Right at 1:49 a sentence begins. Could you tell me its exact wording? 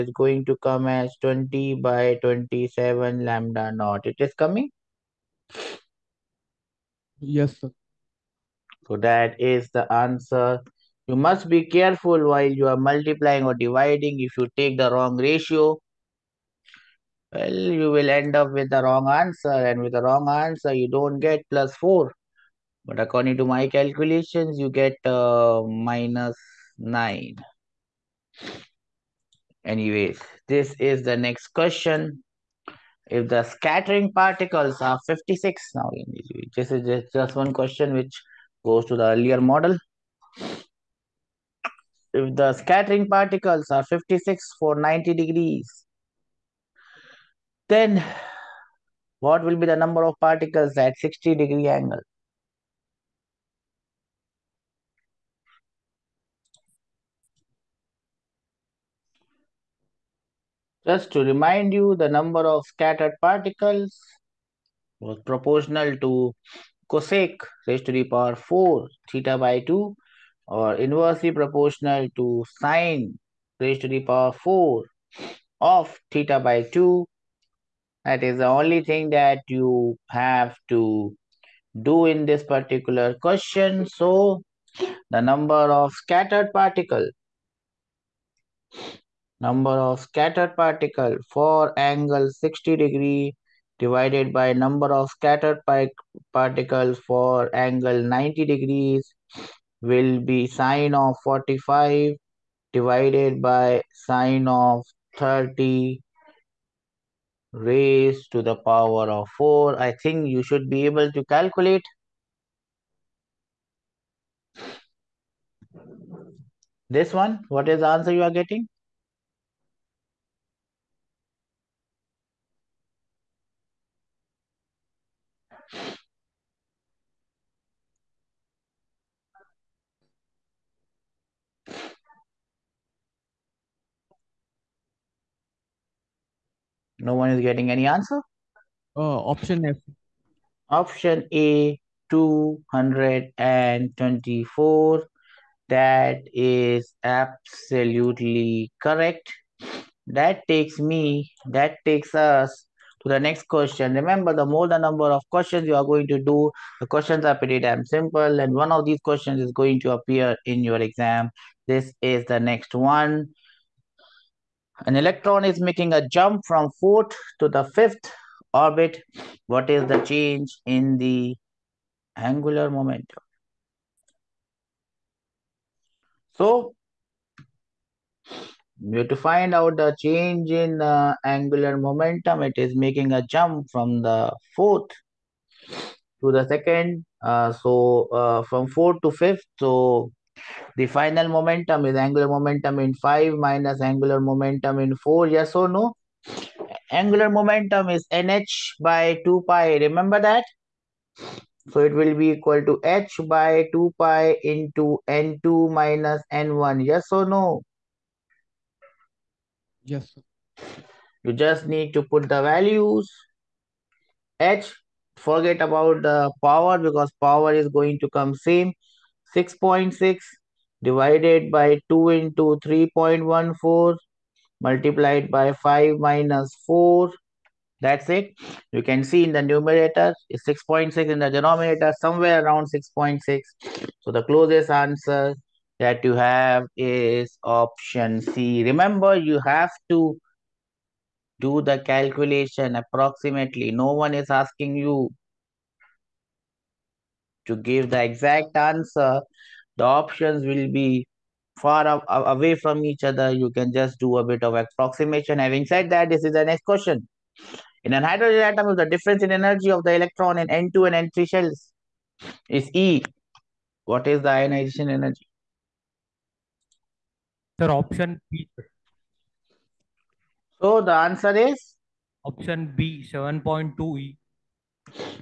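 I think you should be able to calculate.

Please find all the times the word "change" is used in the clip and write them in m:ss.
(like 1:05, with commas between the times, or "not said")
2:50, 2:59.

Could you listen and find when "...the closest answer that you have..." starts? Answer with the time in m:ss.
3:54.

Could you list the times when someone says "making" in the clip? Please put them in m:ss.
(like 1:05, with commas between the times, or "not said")
2:45, 3:02.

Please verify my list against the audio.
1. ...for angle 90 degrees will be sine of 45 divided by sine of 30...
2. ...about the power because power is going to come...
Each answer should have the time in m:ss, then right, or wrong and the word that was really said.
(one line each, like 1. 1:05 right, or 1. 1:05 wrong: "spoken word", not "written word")
1. 1:37 right
2. 3:35 right.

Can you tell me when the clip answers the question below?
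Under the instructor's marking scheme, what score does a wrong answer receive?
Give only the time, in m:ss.
0:25.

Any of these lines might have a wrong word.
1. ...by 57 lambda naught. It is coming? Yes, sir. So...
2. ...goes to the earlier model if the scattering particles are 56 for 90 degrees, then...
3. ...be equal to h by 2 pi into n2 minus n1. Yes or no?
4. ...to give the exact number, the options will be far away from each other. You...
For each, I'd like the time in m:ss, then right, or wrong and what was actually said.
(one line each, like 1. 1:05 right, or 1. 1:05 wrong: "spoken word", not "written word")
1. 0:01 wrong: "27", not "57"
2. 0:38 right
3. 3:22 right
4. 4:07 wrong: "answer", not "number".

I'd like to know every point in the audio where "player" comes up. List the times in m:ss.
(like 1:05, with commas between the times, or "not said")
not said.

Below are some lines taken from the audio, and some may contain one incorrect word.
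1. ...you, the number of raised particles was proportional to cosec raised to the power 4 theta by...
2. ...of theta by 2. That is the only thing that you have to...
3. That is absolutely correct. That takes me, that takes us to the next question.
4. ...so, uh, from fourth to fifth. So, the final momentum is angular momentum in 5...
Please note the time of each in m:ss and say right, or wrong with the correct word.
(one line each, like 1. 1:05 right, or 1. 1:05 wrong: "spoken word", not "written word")
1. 1:01 wrong: "scattered", not "raised"
2. 1:15 right
3. 2:25 right
4. 3:07 right.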